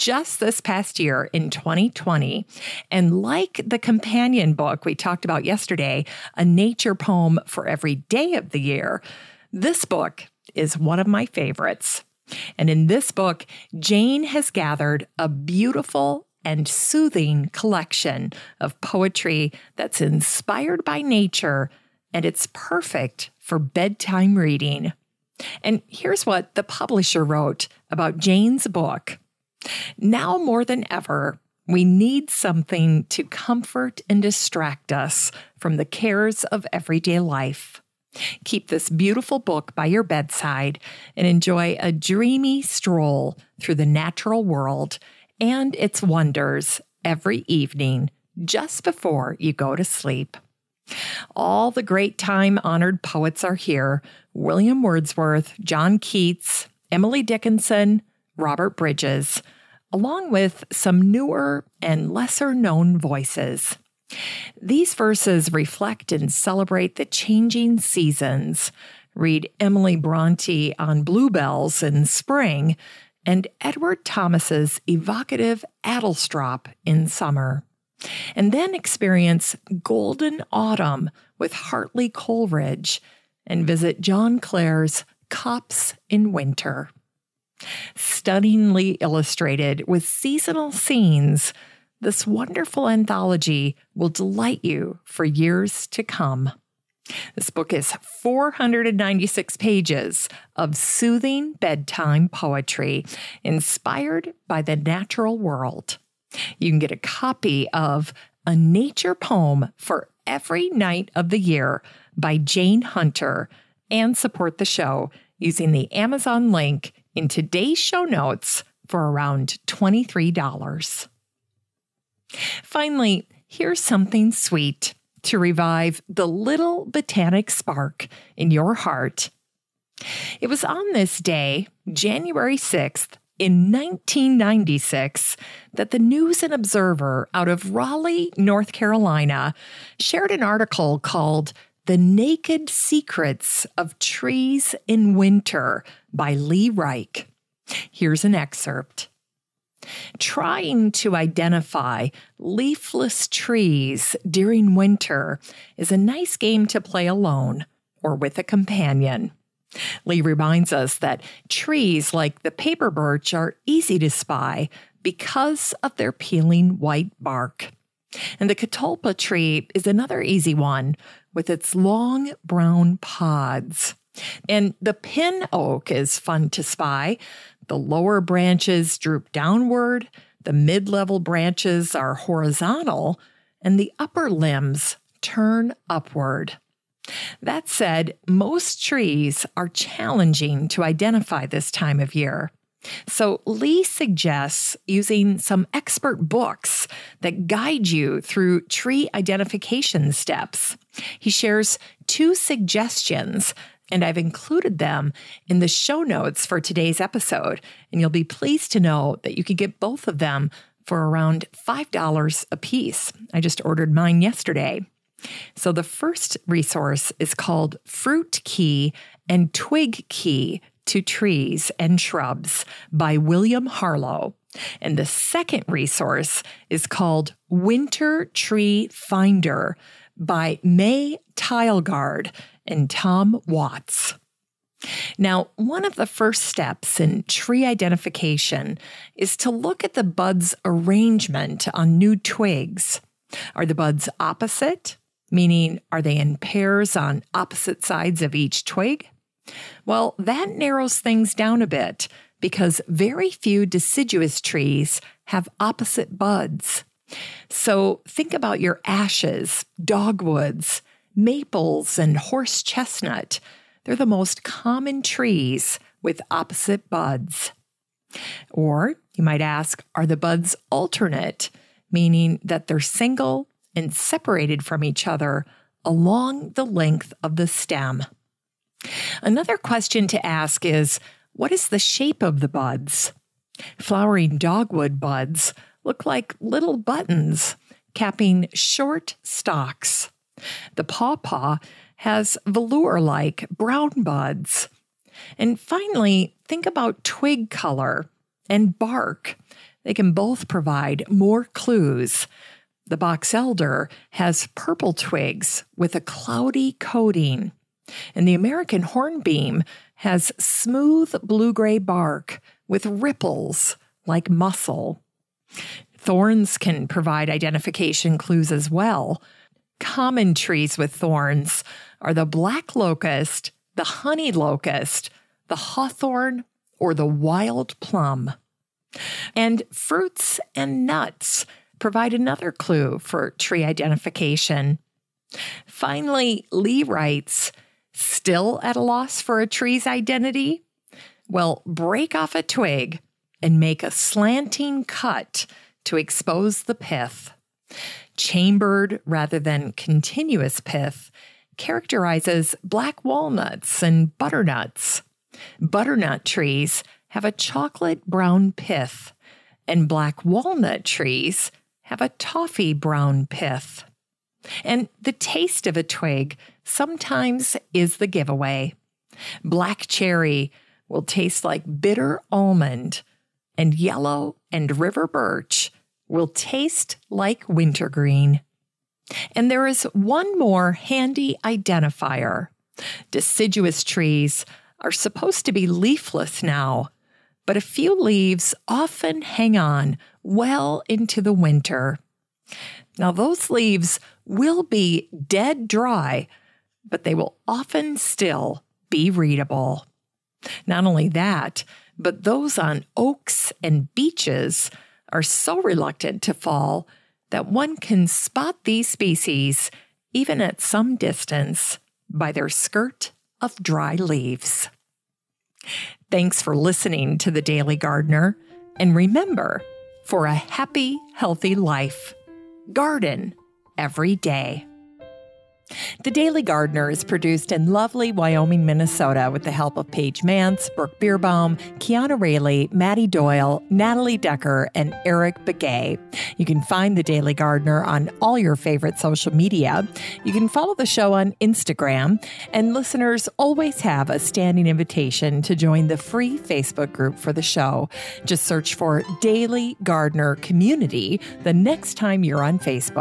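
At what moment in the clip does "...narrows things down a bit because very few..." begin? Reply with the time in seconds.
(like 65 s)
250 s.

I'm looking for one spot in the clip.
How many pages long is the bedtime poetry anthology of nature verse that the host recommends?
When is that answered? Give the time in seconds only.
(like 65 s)
97 s.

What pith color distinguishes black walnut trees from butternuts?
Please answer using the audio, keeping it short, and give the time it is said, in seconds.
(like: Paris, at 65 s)
Toffee brown, at 362 s.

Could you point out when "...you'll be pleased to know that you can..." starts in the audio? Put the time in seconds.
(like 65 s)
207 s.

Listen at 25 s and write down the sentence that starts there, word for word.
And here's what the publisher wrote about Jane's book.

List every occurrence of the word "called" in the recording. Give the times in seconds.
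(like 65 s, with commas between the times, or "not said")
140 s, 217 s, 226 s.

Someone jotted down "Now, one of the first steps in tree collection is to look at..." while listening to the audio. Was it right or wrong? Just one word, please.
wrong.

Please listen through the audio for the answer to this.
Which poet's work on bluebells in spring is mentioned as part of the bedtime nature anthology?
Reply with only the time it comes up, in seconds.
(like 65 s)
69 s.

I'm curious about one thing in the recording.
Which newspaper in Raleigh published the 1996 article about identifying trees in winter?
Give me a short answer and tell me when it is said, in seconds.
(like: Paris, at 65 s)
News and Observer, at 135 s.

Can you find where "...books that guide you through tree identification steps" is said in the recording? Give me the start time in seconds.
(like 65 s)
196 s.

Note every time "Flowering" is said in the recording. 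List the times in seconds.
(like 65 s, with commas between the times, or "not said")
283 s.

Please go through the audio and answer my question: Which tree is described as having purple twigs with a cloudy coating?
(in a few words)
Box elder.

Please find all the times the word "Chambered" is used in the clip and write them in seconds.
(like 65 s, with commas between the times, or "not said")
348 s.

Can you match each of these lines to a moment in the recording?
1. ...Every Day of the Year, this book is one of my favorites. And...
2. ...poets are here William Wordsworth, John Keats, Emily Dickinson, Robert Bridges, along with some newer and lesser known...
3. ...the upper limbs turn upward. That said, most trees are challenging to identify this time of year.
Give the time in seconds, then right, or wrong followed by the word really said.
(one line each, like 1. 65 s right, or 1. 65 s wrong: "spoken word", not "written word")
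1. 7 s right
2. 53 s right
3. 183 s right.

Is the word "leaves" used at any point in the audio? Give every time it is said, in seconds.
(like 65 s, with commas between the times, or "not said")
387 s, 393 s, 413 s.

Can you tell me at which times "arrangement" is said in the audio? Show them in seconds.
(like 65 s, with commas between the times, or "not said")
240 s.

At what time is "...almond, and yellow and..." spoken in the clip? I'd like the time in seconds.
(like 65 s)
372 s.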